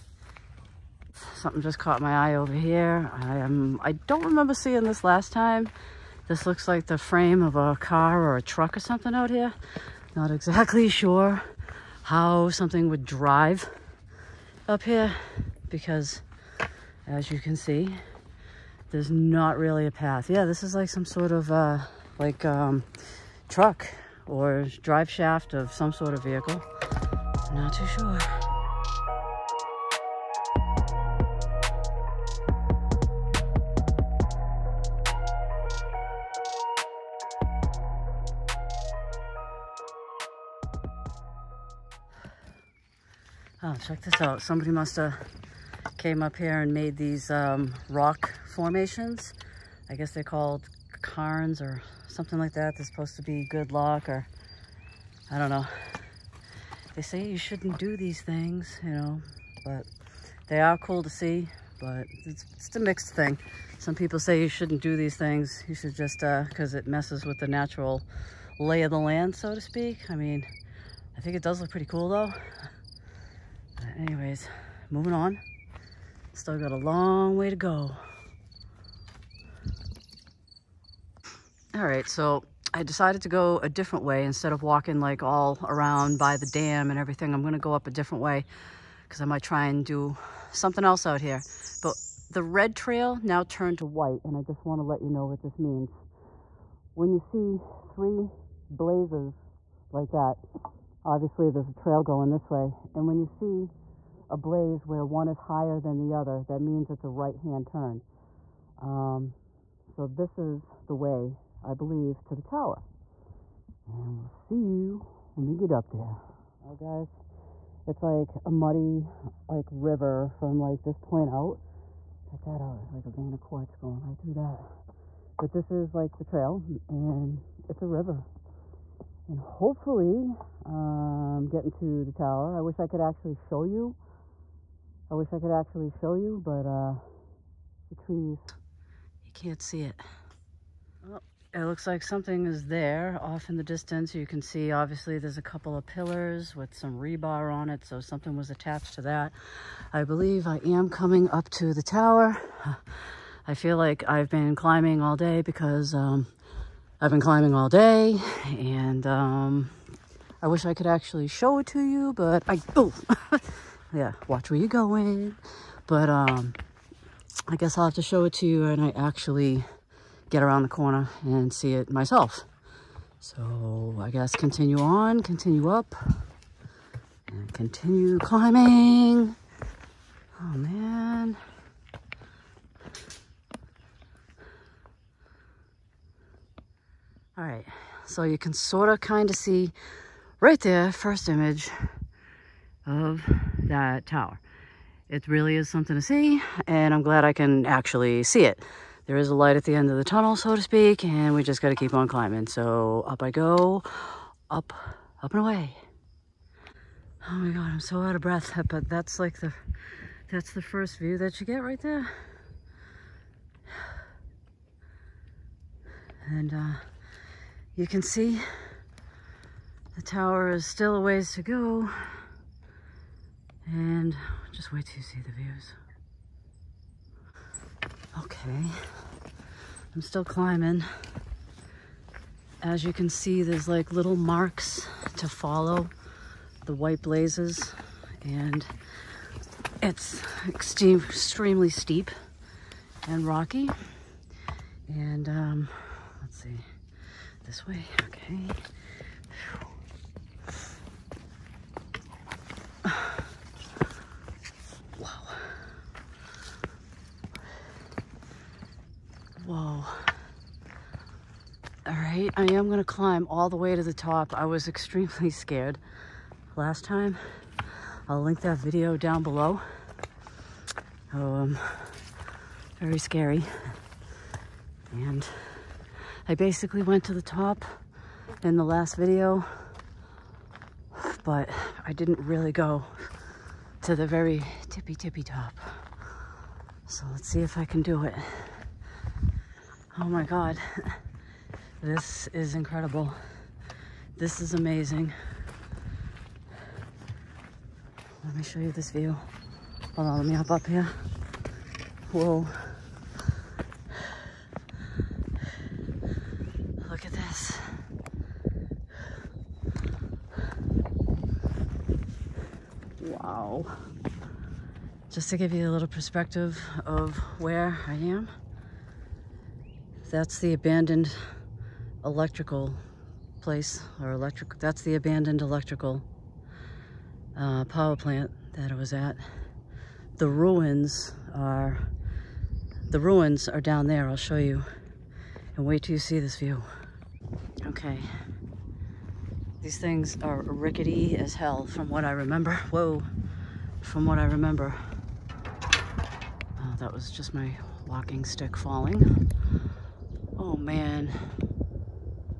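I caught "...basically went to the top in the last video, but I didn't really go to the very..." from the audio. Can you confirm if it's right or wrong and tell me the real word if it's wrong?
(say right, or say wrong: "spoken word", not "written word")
right.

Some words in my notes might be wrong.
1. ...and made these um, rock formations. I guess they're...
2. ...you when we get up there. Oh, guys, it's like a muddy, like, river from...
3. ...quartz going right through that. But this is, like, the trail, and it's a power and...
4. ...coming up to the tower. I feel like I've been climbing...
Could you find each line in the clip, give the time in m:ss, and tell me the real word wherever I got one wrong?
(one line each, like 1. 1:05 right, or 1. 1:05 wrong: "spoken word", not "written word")
1. 0:46 right
2. 1:54 right
3. 2:03 wrong: "river", not "power"
4. 2:30 right.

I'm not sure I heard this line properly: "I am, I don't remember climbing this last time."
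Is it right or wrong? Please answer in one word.
wrong.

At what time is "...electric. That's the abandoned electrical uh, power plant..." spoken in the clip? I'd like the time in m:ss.
5:24.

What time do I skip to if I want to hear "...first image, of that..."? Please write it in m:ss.
3:10.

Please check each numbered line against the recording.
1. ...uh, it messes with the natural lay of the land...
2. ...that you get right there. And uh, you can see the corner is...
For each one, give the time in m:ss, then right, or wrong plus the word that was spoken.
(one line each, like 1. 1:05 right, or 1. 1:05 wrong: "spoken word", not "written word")
1. 1:06 right
2. 3:31 wrong: "tower", not "corner".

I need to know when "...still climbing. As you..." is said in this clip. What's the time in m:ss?
3:50.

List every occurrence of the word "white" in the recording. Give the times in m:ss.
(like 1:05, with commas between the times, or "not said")
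1:33, 3:56.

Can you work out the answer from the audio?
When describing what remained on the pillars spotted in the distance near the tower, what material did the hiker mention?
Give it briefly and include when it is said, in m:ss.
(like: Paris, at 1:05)
rebar, at 2:26.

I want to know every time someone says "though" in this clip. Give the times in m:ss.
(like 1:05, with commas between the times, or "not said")
1:12.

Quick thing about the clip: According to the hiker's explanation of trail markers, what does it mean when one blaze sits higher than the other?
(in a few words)
right-hand turn.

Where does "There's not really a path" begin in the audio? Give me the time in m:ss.
0:18.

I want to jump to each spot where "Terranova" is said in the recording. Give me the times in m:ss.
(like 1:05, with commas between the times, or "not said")
not said.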